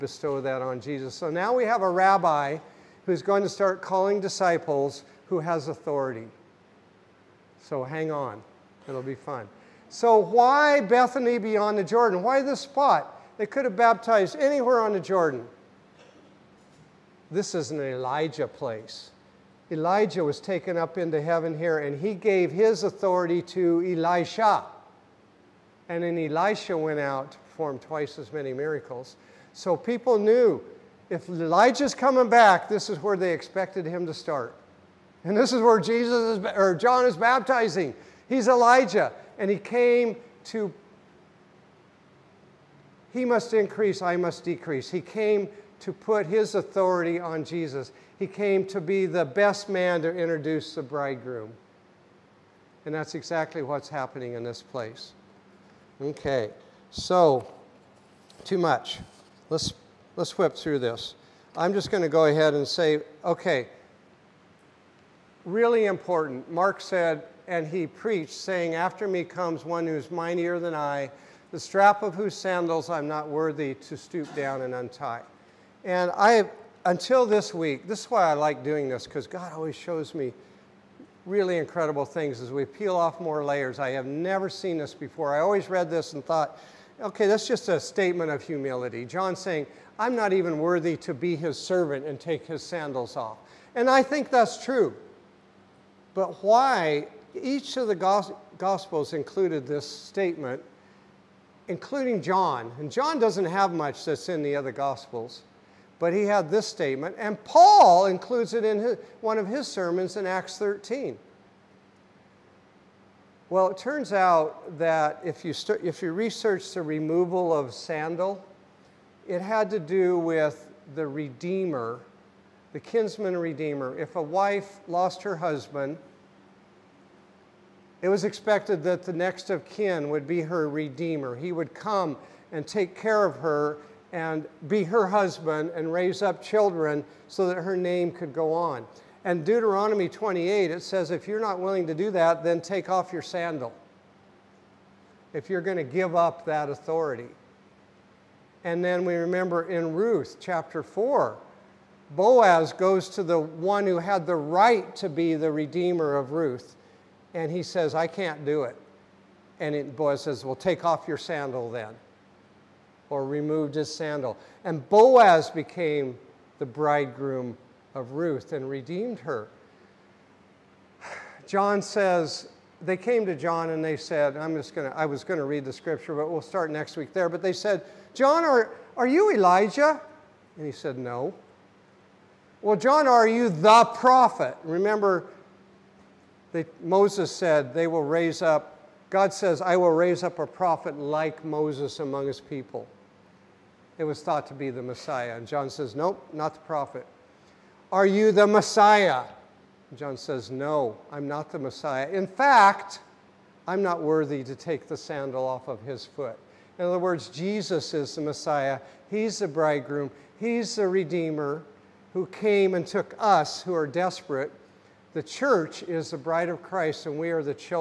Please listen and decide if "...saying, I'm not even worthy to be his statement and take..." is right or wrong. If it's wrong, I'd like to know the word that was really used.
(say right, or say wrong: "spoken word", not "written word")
wrong: "servant", not "statement".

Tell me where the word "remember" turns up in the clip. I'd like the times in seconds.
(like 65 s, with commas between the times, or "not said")
149 s, 184 s.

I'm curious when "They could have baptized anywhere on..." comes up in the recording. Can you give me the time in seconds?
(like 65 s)
13 s.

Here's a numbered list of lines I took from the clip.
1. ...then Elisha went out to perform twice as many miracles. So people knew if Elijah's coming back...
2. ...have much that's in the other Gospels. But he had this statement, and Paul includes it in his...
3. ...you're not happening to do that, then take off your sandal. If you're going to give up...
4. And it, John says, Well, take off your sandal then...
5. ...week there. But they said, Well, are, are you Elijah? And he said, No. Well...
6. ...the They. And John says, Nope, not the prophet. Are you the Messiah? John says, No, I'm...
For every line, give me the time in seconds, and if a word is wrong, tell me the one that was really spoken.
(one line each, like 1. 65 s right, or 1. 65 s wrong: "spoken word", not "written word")
1. 26 s right
2. 103 s right
3. 141 s wrong: "willing", not "happening"
4. 159 s wrong: "Boaz", not "John"
5. 176 s wrong: "John", not "Well"
6. 194 s wrong: "Messiah", not "They".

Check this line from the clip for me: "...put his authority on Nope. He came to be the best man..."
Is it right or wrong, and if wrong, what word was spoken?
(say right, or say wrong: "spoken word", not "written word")
wrong: "Jesus", not "Nope".